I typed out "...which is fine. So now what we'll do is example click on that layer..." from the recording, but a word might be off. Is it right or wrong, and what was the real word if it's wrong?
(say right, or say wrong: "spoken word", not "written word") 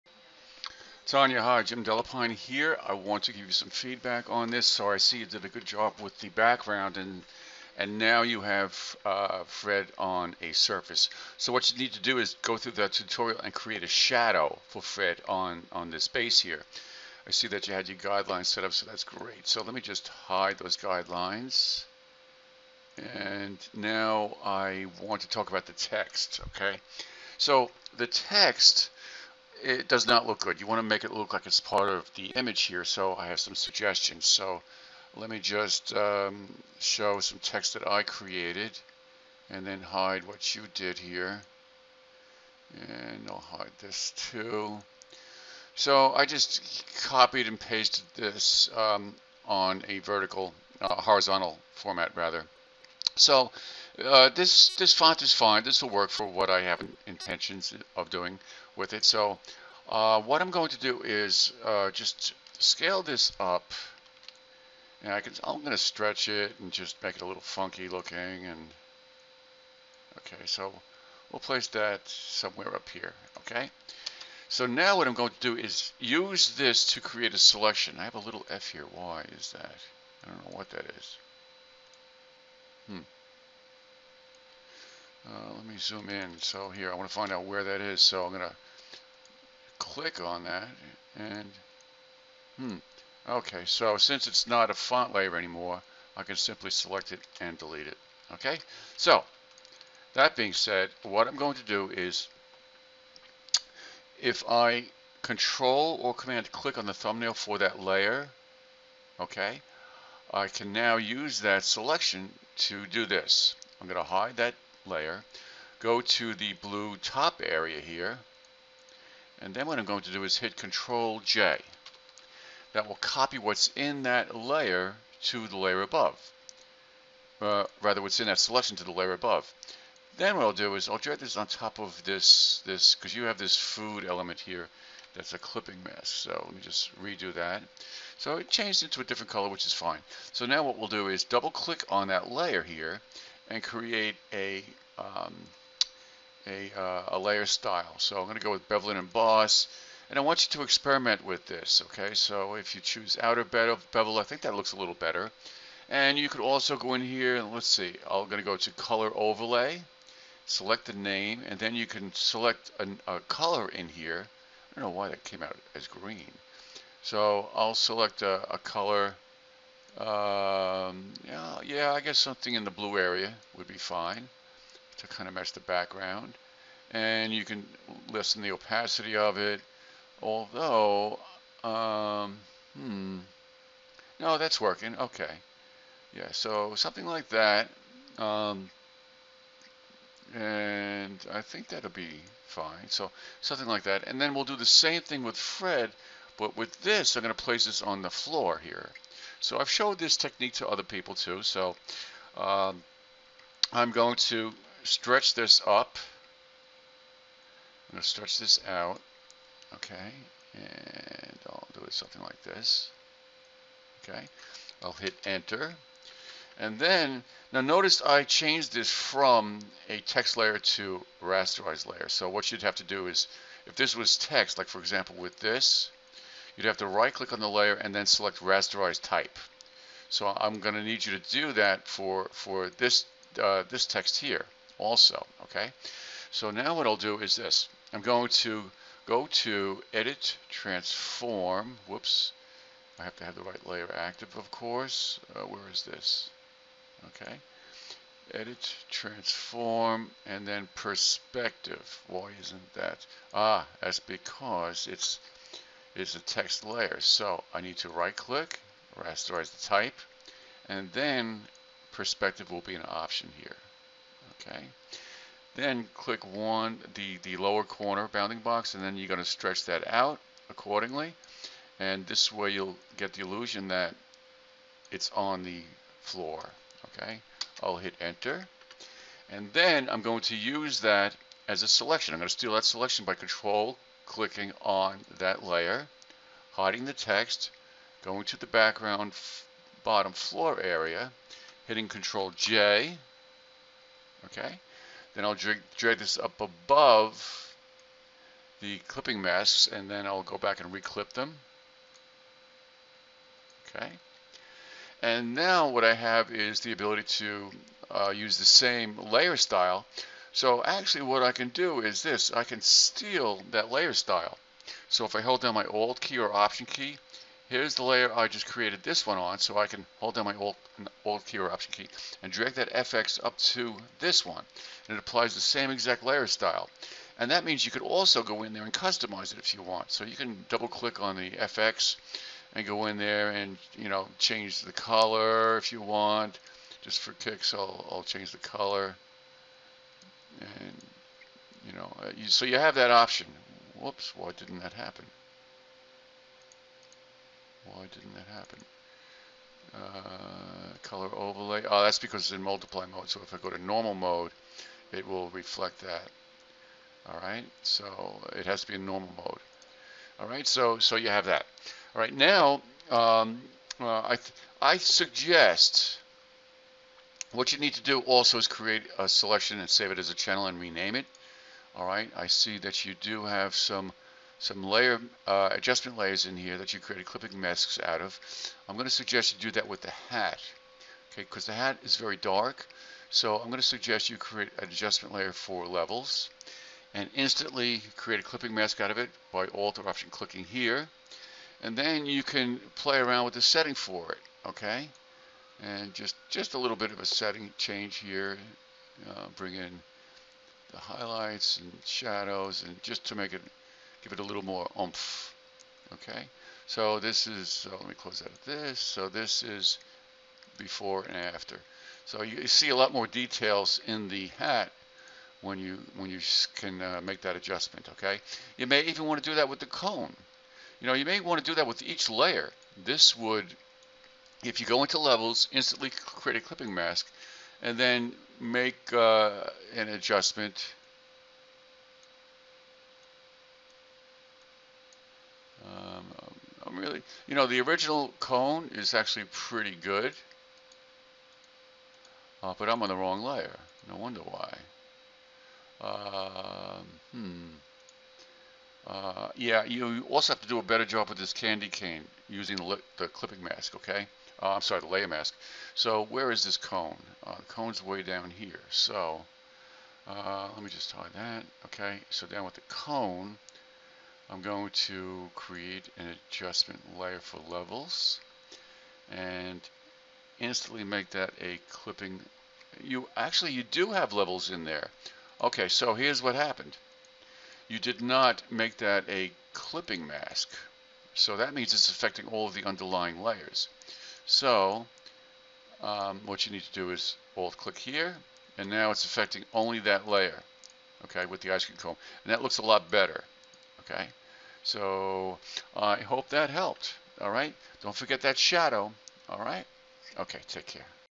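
wrong: "double", not "example".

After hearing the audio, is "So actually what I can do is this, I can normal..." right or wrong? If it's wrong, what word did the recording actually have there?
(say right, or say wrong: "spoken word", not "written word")
wrong: "steal", not "normal".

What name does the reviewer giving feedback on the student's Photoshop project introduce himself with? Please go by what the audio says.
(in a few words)
Jim DeLapine.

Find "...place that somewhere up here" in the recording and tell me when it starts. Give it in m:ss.
1:11.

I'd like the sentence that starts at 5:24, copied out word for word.
And it applies the same exact layer style.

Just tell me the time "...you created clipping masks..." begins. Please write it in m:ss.
6:16.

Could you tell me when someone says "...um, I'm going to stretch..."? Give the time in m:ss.
3:22.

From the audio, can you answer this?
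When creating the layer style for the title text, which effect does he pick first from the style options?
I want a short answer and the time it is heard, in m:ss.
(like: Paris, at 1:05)
Bevel and emboss, at 2:28.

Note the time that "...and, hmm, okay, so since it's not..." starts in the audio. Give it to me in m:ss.
1:31.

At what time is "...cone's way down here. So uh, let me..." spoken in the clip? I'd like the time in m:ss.
7:37.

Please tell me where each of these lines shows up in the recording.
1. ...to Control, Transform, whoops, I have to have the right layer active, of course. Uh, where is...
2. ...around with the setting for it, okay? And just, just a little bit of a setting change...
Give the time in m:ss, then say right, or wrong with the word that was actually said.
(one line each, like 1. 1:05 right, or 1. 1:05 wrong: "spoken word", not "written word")
1. 3:59 wrong: "Edit", not "Control"
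2. 6:32 right.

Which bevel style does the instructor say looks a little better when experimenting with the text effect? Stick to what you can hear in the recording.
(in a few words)
Outer bevel.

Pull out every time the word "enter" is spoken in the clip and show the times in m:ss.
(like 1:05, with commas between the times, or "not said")
3:35, 4:38.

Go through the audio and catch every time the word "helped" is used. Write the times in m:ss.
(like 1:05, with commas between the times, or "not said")
8:16.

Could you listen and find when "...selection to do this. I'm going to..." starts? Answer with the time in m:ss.
1:51.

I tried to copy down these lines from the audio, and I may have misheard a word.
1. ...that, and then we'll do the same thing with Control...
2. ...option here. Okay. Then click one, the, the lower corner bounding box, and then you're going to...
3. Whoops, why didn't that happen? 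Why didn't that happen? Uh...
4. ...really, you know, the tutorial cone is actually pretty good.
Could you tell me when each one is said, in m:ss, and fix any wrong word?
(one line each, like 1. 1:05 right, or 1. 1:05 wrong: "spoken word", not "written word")
1. 3:13 wrong: "Fred", not "Control"
2. 4:22 right
3. 5:43 right
4. 7:16 wrong: "original", not "tutorial".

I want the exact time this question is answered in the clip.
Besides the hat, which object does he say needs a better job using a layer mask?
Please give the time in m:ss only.
7:31.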